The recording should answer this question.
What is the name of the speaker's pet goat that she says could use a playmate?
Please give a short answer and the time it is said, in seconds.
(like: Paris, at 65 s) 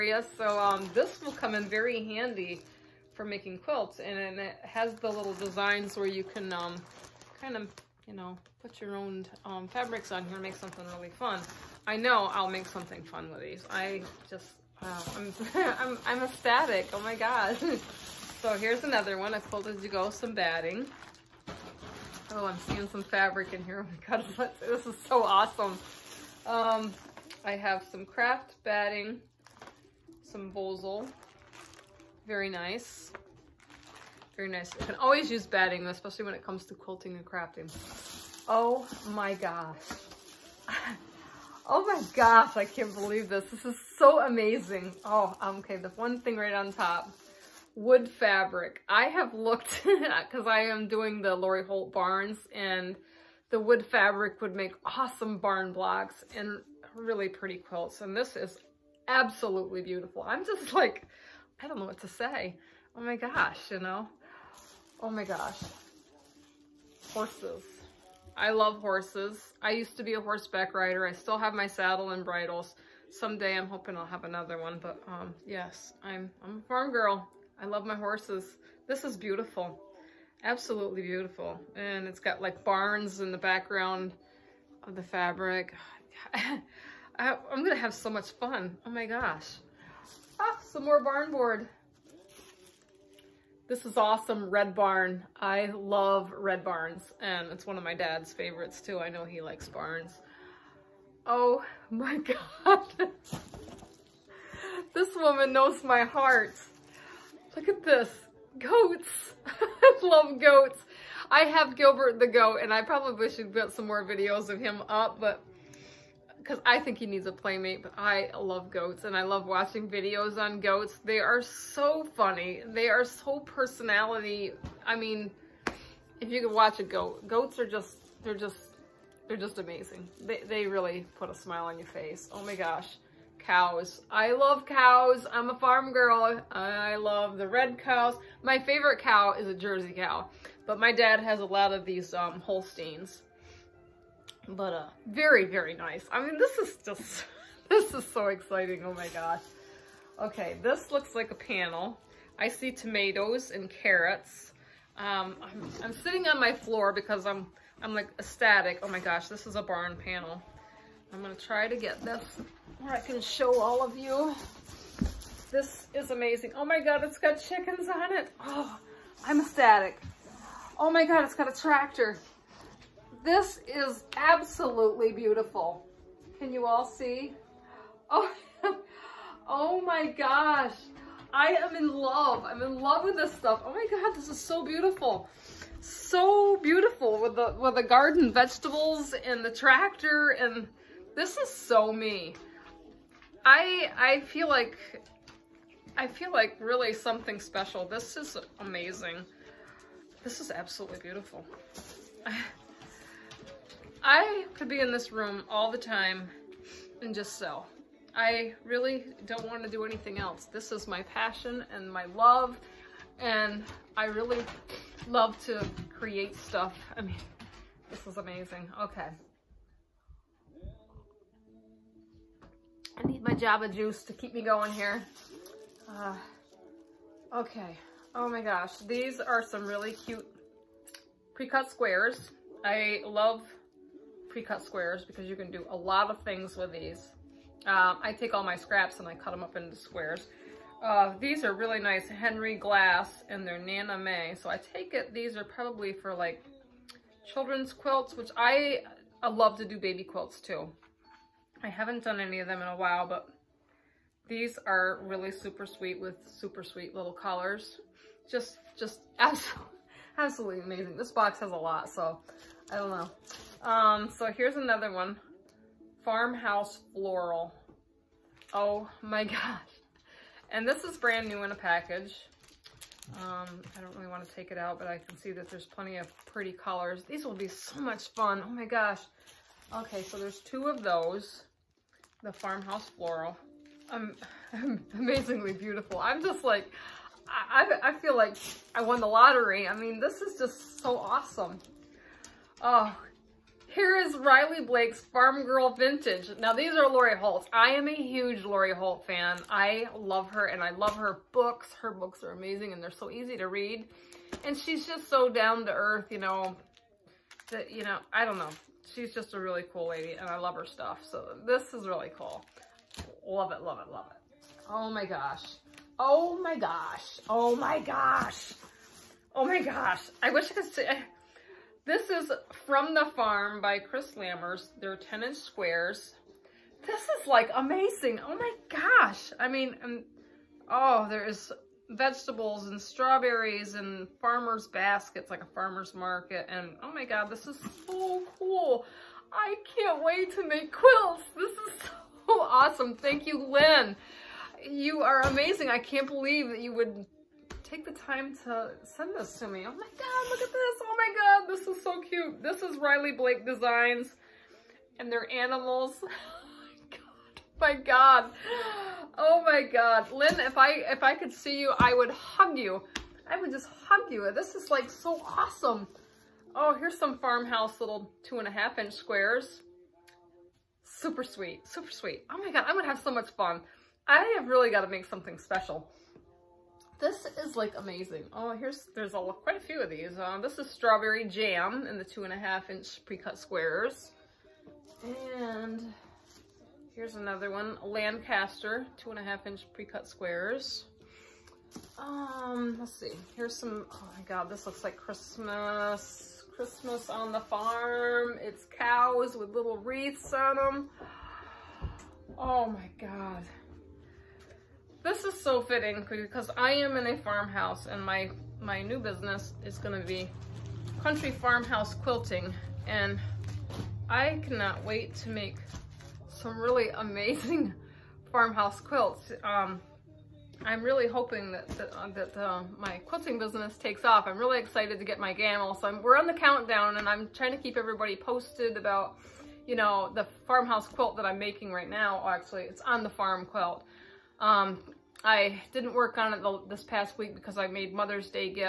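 Gilbert, at 111 s.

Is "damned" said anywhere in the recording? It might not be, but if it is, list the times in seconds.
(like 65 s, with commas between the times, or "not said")
not said.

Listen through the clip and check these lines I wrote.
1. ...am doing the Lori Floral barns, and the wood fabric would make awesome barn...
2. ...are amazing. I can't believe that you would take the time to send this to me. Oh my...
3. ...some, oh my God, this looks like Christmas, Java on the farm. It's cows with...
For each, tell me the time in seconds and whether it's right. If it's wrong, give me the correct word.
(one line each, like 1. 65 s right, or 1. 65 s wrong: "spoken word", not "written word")
1. 50 s wrong: "Holt", not "Floral"
2. 345 s right
3. 393 s wrong: "Christmas", not "Java".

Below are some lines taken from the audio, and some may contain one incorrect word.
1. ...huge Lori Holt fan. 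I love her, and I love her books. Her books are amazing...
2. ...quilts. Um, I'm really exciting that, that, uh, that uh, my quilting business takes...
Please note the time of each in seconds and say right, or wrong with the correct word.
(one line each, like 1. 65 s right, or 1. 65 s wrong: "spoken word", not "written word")
1. 297 s right
2. 418 s wrong: "hoping", not "exciting".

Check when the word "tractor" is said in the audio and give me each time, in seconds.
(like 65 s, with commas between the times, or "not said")
171 s, 189 s.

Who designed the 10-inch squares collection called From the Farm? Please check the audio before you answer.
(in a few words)
Kris Lammers.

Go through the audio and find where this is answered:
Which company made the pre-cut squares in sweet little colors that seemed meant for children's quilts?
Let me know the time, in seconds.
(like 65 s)
242 s.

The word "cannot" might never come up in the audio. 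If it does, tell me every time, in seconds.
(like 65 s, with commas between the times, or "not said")
414 s.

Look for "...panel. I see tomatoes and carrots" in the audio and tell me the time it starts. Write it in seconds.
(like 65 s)
151 s.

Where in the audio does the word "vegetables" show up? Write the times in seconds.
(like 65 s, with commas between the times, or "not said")
188 s, 331 s.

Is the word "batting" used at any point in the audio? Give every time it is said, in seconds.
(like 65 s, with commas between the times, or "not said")
20 s, 28 s, 35 s.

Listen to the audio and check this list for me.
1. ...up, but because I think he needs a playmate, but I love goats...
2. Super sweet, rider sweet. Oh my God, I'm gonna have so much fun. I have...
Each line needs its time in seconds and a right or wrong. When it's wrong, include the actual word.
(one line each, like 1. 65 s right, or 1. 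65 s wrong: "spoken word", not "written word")
1. 114 s right
2. 370 s wrong: "super", not "rider".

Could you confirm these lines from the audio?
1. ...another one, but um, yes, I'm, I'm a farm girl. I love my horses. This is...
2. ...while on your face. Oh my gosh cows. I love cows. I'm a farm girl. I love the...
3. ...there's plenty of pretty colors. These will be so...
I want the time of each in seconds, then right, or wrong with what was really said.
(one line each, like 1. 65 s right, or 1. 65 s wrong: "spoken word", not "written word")
1. 74 s right
2. 131 s wrong: "smile", not "while"
3. 275 s right.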